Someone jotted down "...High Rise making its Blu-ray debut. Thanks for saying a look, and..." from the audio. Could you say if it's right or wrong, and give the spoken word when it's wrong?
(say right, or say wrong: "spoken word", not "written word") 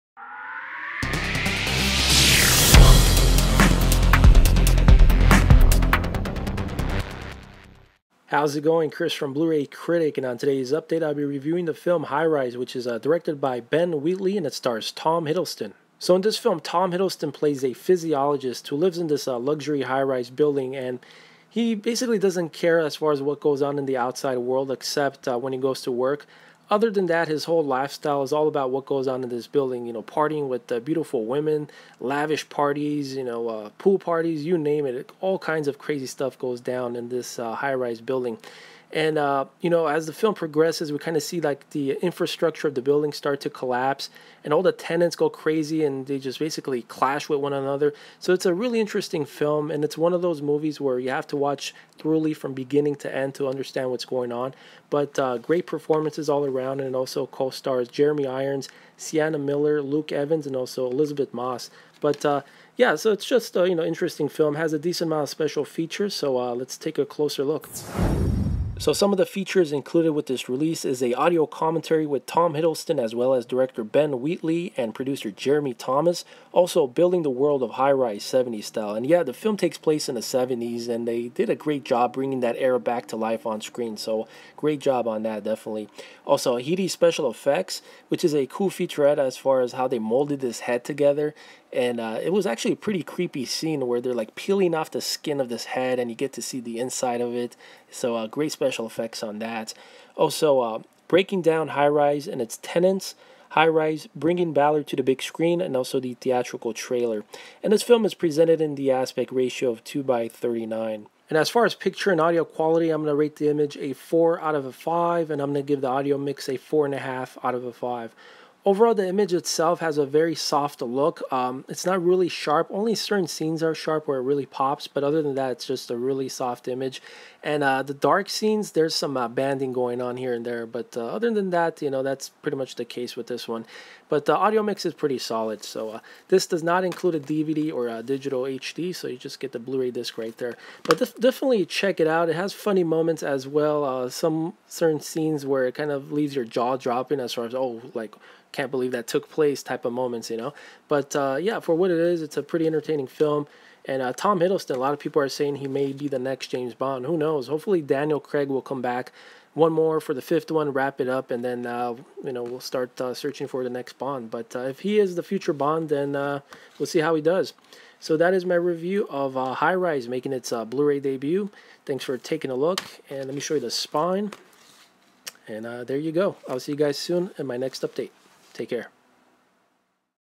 wrong: "taking", not "saying".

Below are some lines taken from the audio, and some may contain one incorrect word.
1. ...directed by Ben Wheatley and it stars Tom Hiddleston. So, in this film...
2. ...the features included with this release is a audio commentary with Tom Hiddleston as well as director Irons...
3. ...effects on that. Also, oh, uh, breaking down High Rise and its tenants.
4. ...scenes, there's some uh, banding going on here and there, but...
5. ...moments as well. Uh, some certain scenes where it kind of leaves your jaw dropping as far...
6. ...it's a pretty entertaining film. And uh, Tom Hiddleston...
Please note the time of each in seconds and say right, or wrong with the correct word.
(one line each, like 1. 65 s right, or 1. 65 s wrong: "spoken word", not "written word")
1. 12 s right
2. 69 s wrong: "Ben", not "Irons"
3. 98 s right
4. 128 s right
5. 142 s right
6. 152 s right.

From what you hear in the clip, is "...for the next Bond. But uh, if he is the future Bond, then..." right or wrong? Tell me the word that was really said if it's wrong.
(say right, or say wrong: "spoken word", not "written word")
right.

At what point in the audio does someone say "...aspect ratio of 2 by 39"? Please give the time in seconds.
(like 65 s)
108 s.